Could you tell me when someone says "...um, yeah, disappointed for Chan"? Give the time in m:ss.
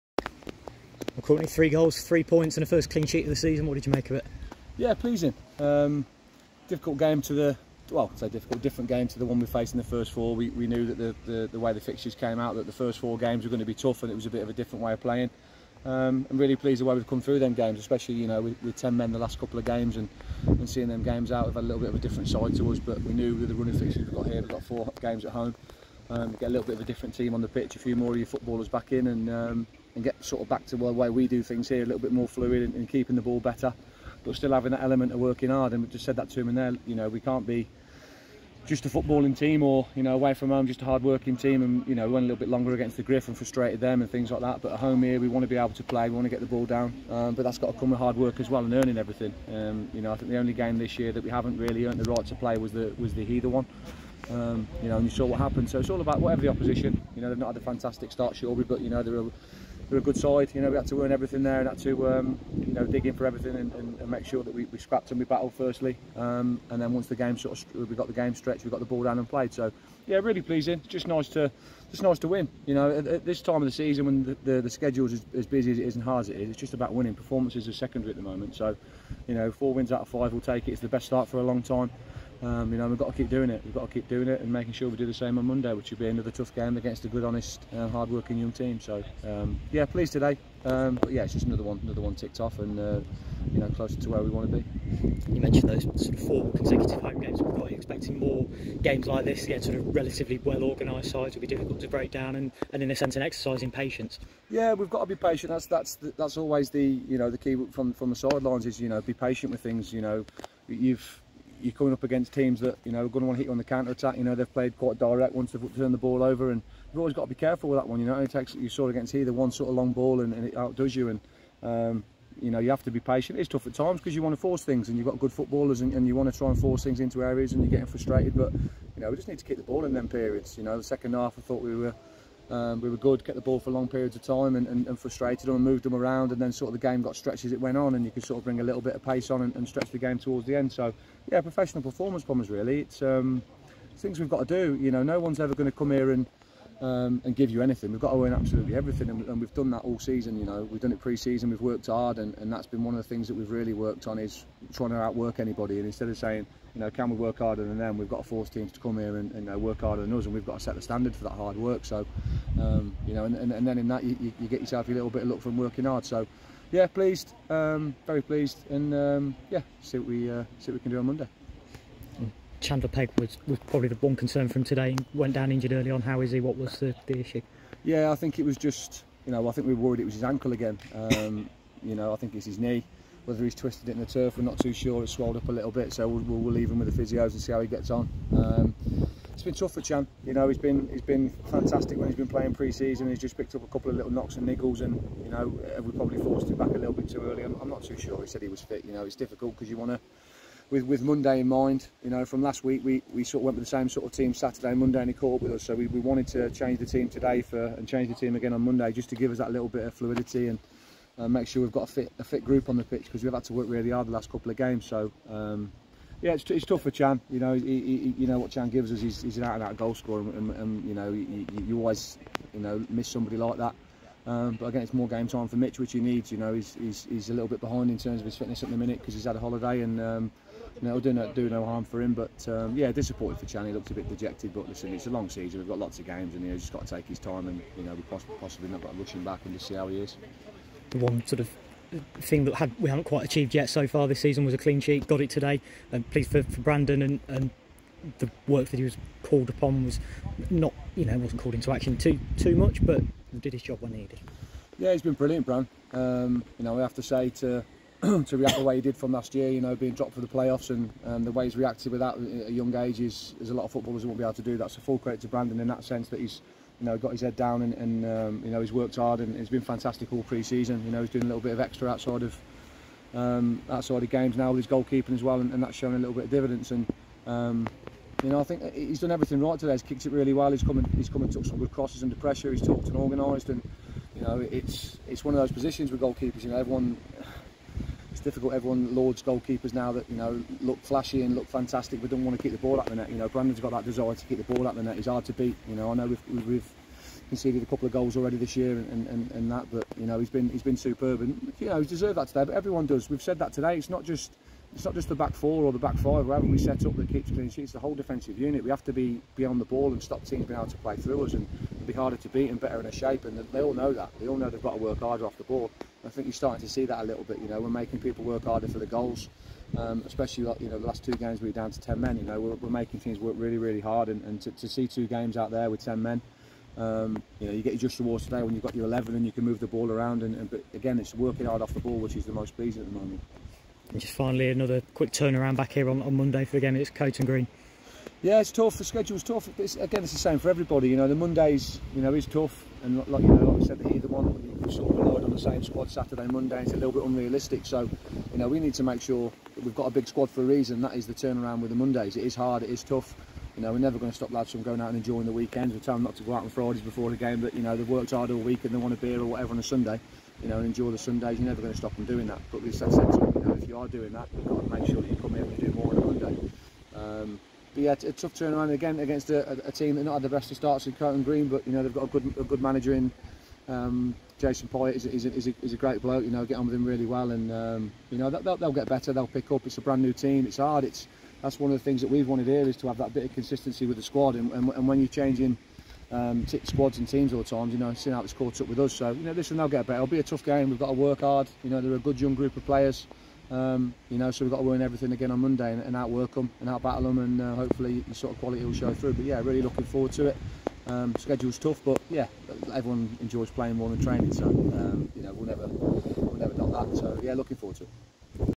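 3:52.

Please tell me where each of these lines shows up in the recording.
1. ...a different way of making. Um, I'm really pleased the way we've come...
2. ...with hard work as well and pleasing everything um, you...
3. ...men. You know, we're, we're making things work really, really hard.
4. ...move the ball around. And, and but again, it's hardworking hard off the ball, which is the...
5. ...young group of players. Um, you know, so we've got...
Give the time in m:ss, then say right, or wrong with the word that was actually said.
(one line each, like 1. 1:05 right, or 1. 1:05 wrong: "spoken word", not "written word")
1. 0:14 wrong: "playing", not "making"
2. 0:47 wrong: "earning", not "pleasing"
3. 5:22 right
4. 5:29 wrong: "working", not "hardworking"
5. 6:32 right.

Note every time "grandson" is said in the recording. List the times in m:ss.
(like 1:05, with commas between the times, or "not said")
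not said.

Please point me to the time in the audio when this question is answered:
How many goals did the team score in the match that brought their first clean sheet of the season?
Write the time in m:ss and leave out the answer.
0:01.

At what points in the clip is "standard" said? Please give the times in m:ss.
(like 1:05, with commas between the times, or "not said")
2:40.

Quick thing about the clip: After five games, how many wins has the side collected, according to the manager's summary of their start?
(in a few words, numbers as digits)
4.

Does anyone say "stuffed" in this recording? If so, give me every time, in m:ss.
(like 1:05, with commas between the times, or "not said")
not said.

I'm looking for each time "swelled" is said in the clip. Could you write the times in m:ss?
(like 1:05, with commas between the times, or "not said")
3:05.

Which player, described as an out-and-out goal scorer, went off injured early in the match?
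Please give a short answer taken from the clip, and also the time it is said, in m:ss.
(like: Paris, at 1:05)
Chandler Pegg, at 2:52.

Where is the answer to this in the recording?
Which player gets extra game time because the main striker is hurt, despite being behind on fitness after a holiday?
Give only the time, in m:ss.
3:45.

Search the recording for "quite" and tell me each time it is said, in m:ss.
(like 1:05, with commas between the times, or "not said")
1:54, 4:03.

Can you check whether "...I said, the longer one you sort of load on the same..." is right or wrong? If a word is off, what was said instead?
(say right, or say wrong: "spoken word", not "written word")
wrong: "either", not "longer".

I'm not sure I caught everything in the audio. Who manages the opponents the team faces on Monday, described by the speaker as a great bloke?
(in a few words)
Jason Poyet.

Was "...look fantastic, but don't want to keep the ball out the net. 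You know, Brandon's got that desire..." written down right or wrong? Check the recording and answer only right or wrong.
right.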